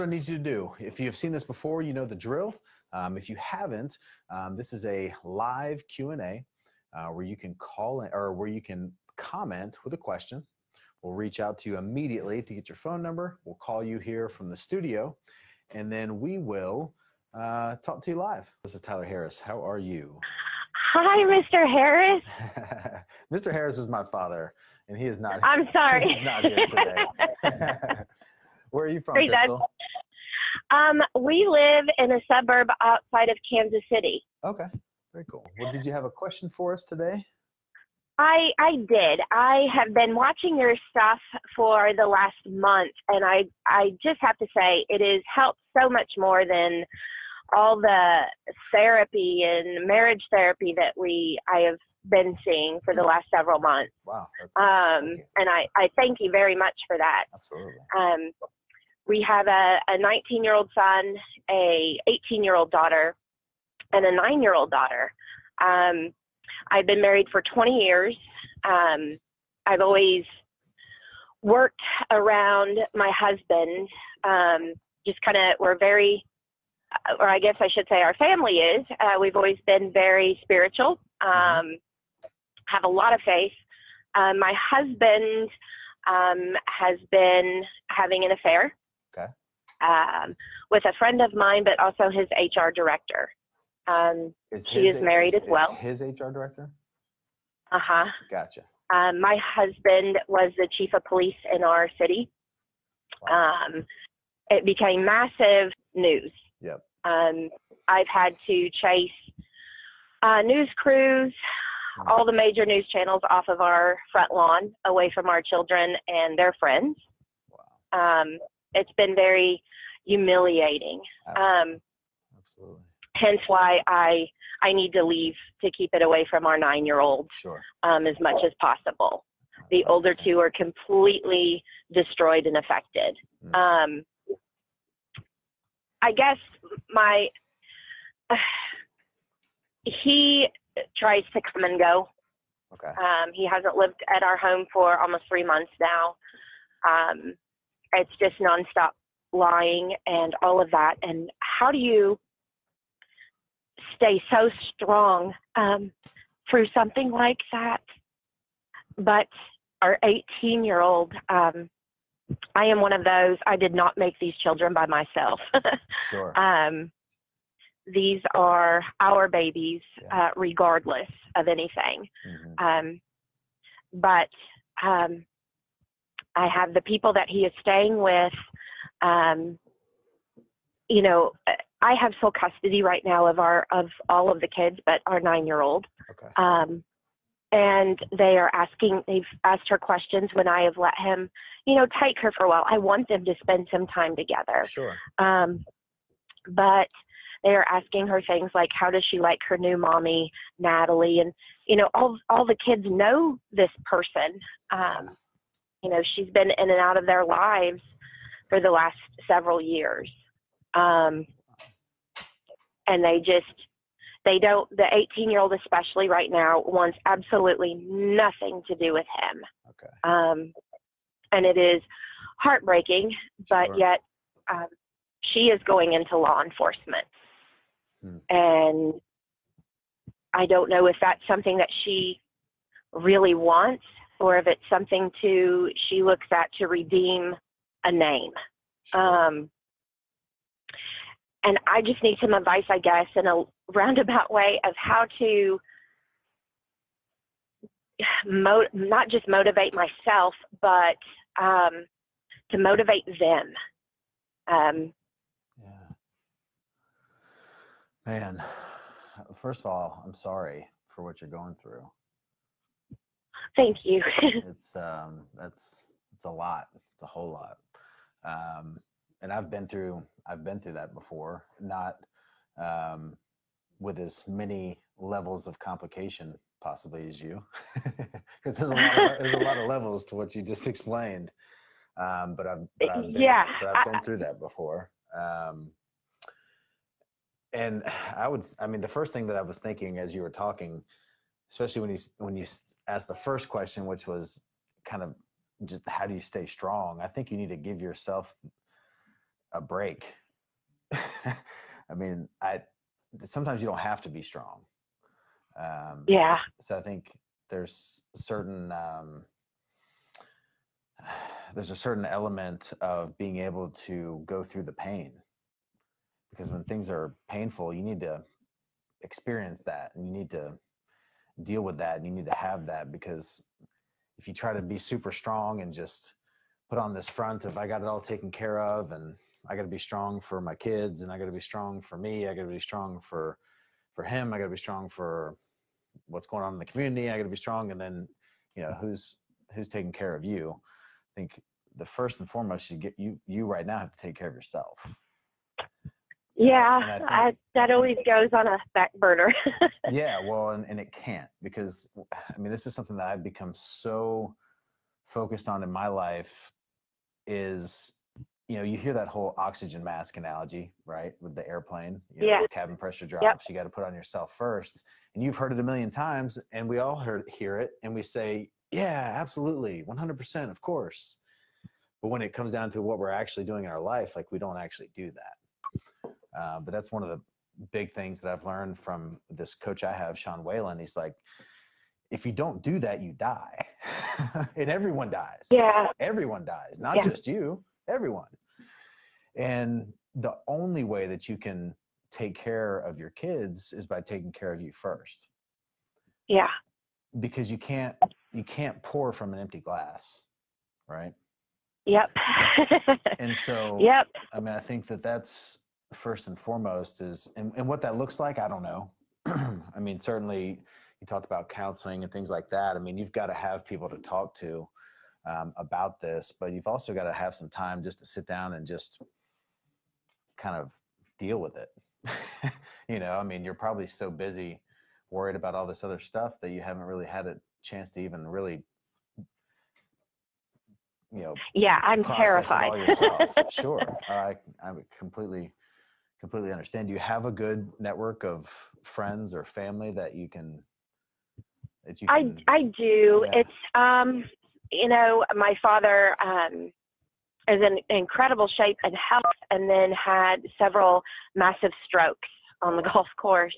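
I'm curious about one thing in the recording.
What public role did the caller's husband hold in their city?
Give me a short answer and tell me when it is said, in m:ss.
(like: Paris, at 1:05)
chief of police, at 1:40.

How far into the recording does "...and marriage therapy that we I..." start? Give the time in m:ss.
0:49.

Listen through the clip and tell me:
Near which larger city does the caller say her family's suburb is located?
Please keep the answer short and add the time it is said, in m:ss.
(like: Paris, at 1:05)
Kansas City, at 0:33.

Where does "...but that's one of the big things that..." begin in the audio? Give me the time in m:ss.
6:16.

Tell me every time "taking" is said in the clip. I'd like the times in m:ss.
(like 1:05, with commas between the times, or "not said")
5:39, 6:34.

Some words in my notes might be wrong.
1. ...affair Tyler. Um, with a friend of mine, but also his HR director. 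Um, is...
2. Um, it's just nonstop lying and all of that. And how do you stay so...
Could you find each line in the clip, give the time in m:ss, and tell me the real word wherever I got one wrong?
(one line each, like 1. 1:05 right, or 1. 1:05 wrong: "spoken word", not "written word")
1. 1:28 wrong: "Okay", not "Tyler"
2. 2:26 right.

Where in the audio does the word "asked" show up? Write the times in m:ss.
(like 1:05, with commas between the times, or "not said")
3:09, 4:52.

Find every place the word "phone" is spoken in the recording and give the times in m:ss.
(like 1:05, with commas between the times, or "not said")
0:12.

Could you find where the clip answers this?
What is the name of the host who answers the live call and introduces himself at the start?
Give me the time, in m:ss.
0:18.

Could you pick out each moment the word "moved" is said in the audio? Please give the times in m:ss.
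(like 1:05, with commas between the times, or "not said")
not said.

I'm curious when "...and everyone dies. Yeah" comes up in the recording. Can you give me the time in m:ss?
6:24.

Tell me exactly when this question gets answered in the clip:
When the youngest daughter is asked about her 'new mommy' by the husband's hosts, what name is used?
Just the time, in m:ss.
3:20.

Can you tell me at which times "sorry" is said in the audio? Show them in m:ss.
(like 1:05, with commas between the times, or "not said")
0:25, 4:20.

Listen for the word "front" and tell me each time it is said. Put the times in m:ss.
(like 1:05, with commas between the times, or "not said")
1:54, 5:27.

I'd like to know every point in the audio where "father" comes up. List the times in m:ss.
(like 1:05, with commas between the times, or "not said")
0:24, 7:25.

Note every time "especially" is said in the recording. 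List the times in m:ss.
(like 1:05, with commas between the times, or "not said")
3:35, 4:51.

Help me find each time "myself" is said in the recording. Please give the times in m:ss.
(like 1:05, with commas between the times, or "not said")
2:44, 4:09.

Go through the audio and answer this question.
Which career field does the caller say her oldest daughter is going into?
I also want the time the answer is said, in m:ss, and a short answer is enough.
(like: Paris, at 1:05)
law enforcement, at 3:46.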